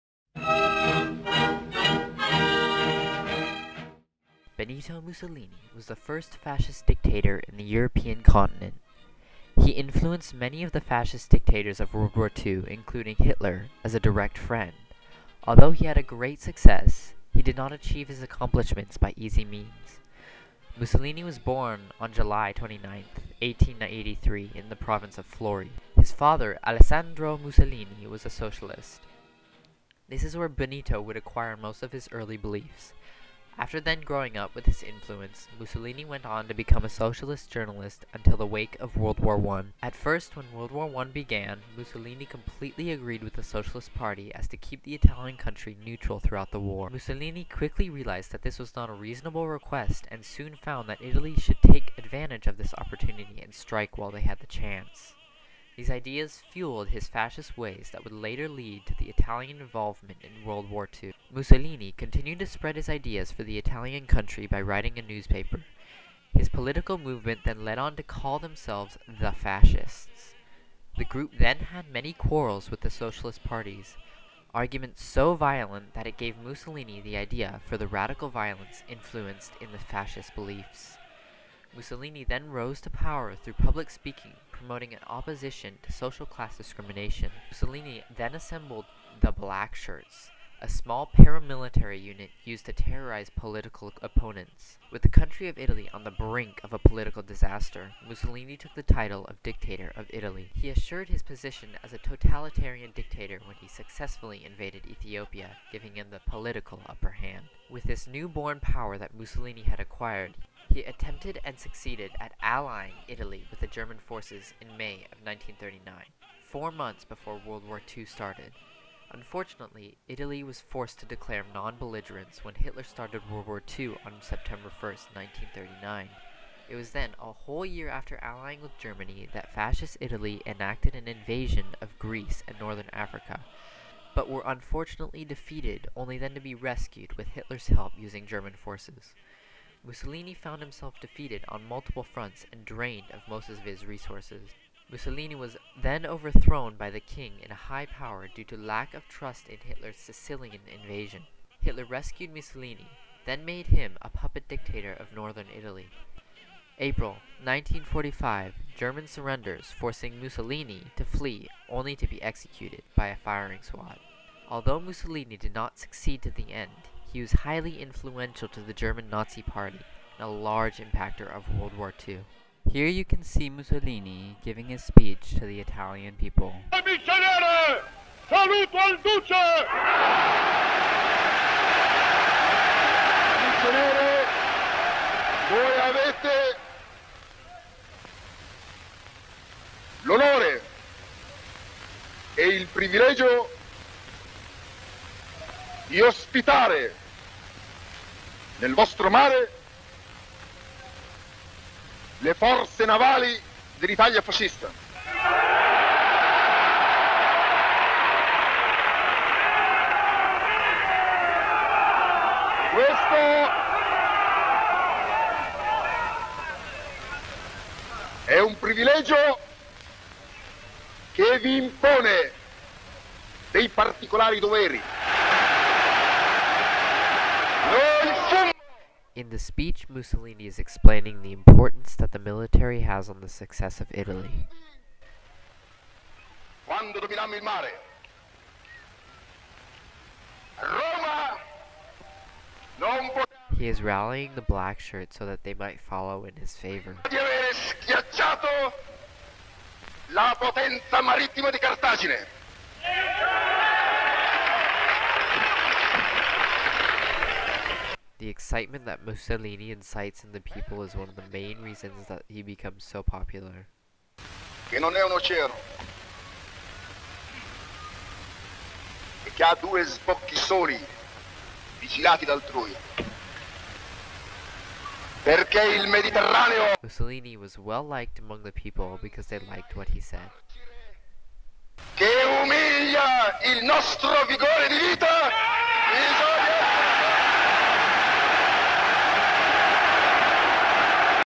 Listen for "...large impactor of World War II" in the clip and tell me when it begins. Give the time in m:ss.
2:50.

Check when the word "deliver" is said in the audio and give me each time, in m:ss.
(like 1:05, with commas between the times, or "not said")
not said.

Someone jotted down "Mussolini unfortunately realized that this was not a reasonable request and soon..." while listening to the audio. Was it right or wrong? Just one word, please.
wrong.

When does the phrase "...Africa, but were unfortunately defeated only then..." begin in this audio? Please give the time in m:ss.
2:12.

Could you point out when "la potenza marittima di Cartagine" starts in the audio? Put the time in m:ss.
4:10.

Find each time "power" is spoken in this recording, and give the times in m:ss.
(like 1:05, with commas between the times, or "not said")
1:22, 1:48, 2:27.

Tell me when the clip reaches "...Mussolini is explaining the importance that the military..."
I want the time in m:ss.
3:49.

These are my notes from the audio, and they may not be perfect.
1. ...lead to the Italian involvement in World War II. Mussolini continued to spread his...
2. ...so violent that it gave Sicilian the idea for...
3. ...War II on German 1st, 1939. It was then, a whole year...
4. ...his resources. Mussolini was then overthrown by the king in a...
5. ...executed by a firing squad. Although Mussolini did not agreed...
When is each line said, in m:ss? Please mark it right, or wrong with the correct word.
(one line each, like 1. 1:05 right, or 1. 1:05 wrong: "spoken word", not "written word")
1. 0:58 right
2. 1:15 wrong: "Mussolini", not "Sicilian"
3. 2:03 wrong: "September", not "German"
4. 2:23 right
5. 2:42 wrong: "succeed", not "agreed".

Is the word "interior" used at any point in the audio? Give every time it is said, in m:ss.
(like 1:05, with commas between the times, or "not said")
not said.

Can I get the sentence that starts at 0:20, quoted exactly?
Mussolini was born on July 29, 1883, in the province of Forlì.